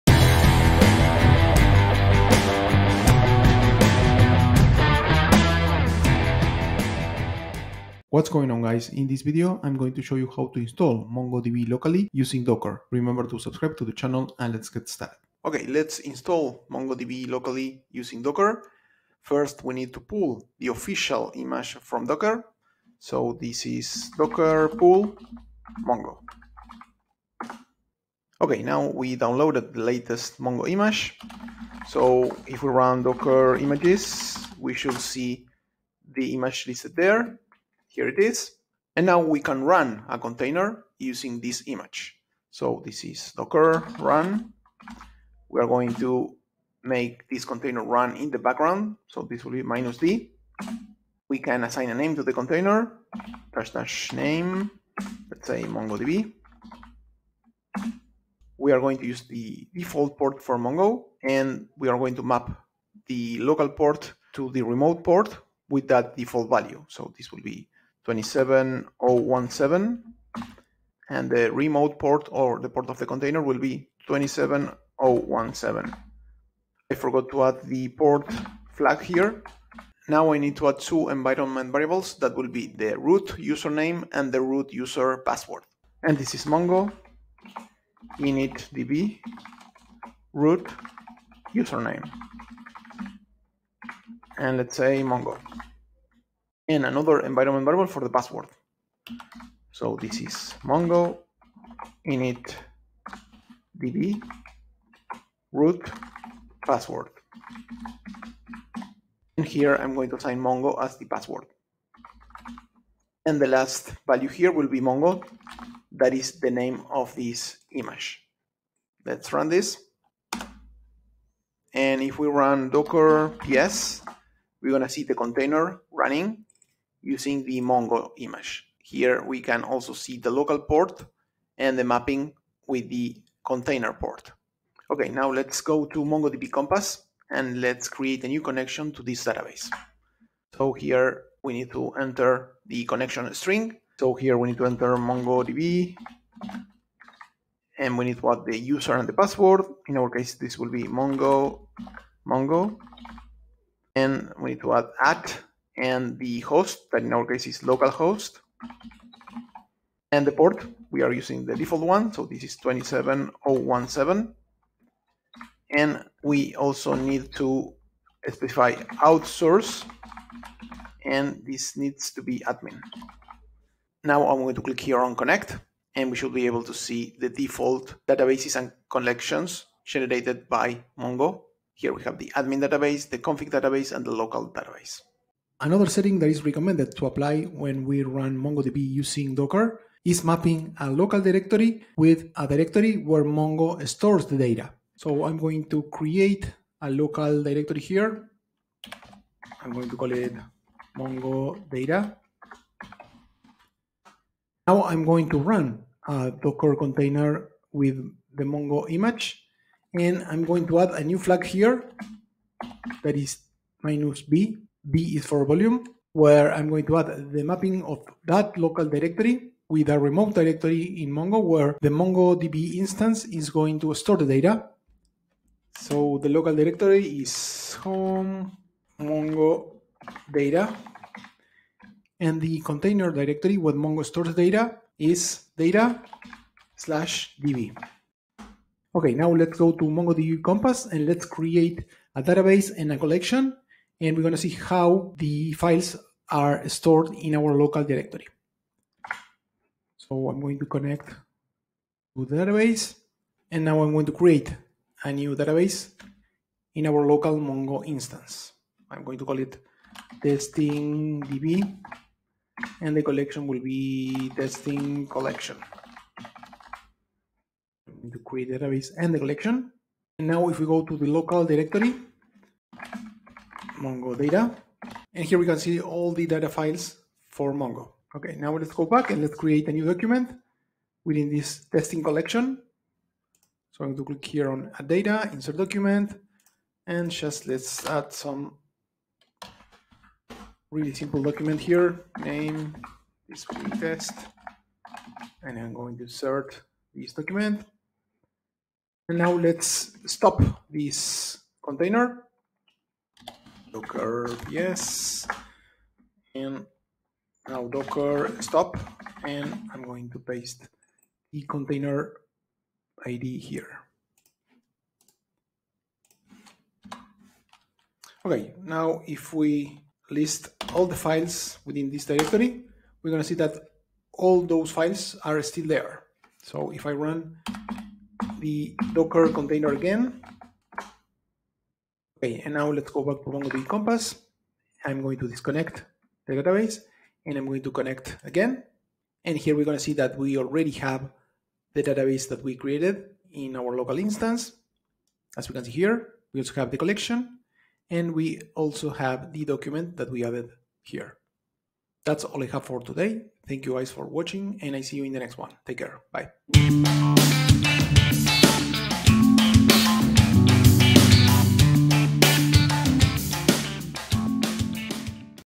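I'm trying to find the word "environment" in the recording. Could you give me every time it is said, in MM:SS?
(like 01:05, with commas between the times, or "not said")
01:21, 01:37.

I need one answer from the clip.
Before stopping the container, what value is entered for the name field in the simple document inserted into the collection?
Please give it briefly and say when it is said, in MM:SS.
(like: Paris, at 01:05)
display test, at 04:53.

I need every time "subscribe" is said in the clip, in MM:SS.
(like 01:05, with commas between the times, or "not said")
00:13.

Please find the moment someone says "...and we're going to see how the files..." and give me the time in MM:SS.
04:04.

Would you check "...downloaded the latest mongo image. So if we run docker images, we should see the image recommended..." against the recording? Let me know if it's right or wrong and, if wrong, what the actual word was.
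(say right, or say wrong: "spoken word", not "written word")
wrong: "listed", not "recommended".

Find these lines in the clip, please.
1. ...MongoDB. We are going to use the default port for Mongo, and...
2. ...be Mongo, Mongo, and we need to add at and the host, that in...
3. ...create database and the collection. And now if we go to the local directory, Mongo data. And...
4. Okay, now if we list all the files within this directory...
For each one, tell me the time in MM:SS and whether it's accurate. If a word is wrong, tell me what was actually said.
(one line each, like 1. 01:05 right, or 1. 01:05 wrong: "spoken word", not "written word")
1. 00:55 right
2. 02:30 right
3. 04:28 right
4. 05:18 right.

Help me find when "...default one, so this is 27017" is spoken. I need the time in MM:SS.
02:41.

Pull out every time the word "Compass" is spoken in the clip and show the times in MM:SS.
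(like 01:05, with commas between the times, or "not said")
02:16, 04:00, 05:33.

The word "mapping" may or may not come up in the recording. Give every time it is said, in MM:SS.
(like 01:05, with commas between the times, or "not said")
02:11, 03:10, 03:37.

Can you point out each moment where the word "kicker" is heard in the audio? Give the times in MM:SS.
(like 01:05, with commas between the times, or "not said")
not said.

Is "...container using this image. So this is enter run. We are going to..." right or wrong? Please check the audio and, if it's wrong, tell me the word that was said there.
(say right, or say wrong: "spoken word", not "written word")
wrong: "docker", not "enter".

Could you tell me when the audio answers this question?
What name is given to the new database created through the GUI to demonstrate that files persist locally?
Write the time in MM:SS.
04:20.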